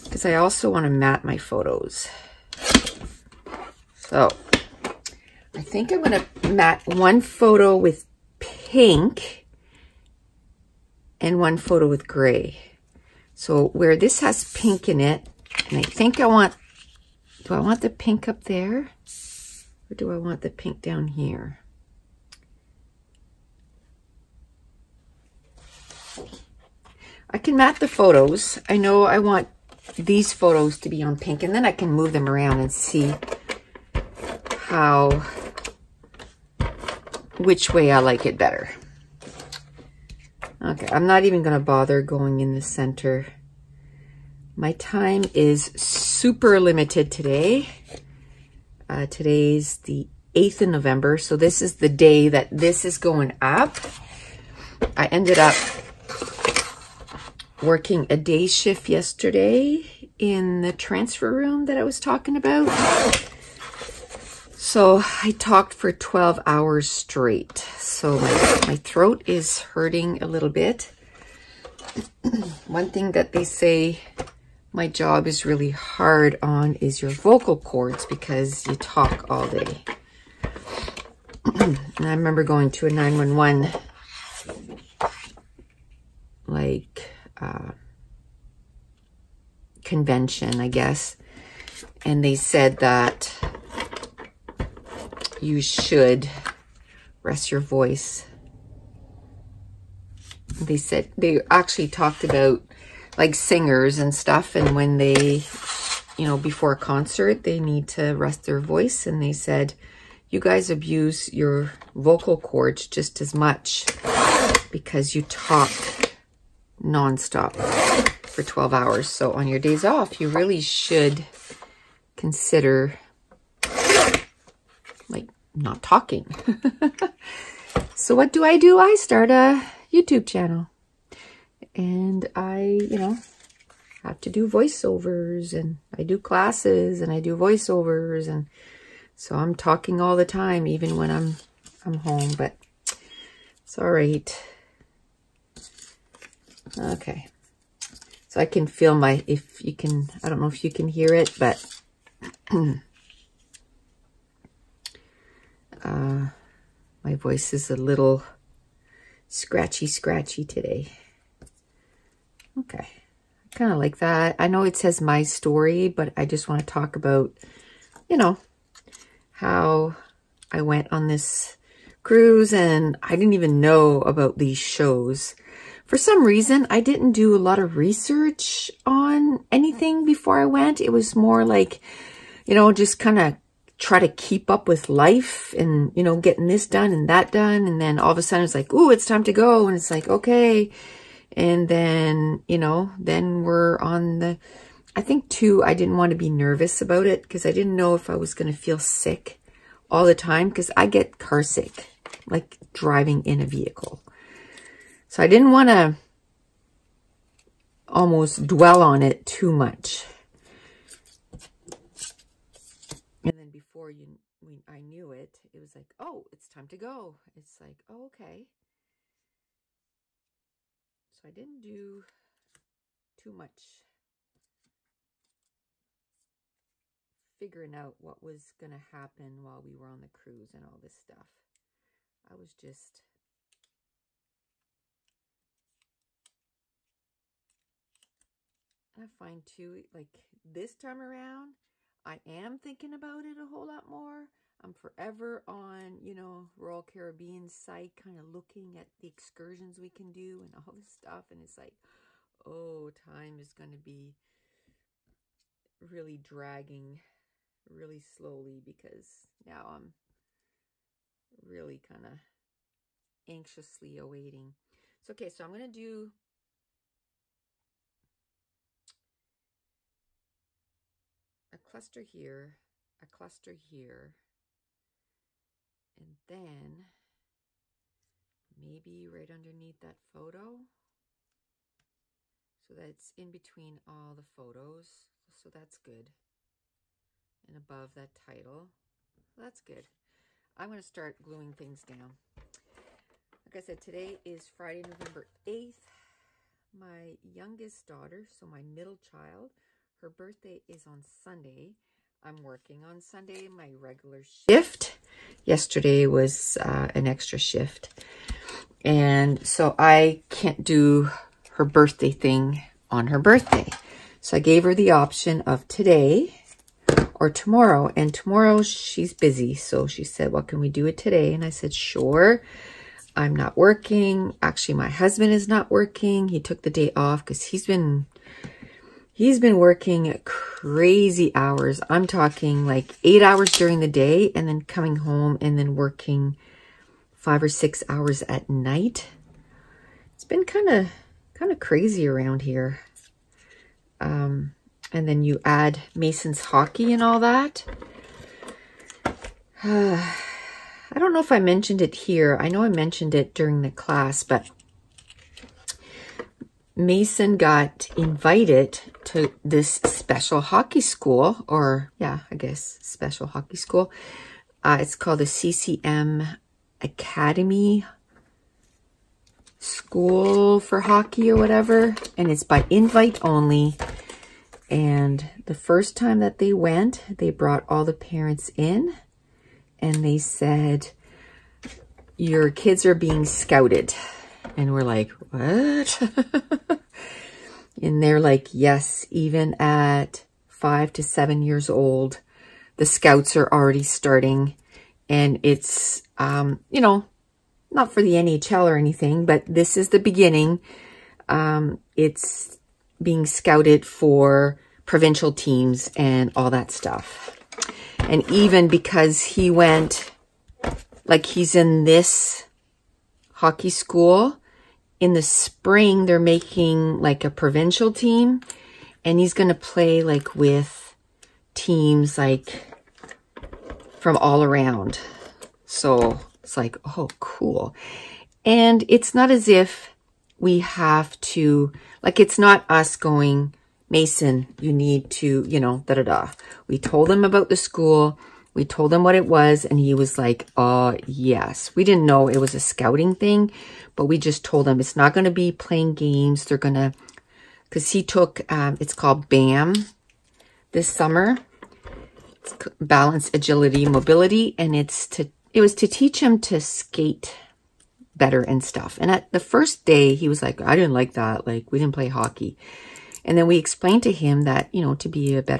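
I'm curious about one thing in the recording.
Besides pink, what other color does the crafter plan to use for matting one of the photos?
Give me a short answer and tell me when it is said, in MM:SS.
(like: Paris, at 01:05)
gray, at 00:12.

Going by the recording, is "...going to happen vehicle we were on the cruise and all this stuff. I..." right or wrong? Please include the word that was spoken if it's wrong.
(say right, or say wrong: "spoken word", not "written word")
wrong: "while", not "vehicle".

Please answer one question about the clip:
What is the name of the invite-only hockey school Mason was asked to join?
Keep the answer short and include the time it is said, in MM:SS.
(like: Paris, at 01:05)
CCM Academy, at 06:05.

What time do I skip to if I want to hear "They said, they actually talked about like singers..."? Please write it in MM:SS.
01:40.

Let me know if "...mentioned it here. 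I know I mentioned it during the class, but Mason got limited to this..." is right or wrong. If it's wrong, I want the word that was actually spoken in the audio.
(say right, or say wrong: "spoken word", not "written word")
wrong: "invited", not "limited".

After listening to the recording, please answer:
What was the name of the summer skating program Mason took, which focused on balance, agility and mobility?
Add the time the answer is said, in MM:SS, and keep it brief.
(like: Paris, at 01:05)
BAM, at 07:29.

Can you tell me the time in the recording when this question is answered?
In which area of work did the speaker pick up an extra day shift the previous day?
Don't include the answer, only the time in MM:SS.
01:00.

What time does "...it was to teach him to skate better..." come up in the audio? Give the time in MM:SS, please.
07:35.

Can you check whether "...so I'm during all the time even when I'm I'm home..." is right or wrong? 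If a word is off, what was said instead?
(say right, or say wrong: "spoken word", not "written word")
wrong: "talking", not "during".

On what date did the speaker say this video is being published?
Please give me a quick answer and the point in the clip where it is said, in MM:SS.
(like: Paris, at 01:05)
November 8, at 00:50.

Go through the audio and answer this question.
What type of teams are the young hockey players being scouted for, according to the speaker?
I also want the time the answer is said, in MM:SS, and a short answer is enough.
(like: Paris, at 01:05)
provincial teams, at 06:44.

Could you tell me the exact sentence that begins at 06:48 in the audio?
And even because he went, like he's in this hockey school.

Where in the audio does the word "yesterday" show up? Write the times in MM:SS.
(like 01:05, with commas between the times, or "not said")
00:58, 05:05.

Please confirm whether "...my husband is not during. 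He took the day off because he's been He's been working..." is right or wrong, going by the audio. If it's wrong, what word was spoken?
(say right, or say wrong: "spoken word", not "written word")
wrong: "working", not "during".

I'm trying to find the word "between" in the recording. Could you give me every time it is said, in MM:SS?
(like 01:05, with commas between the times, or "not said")
04:43.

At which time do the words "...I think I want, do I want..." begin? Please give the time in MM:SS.
00:15.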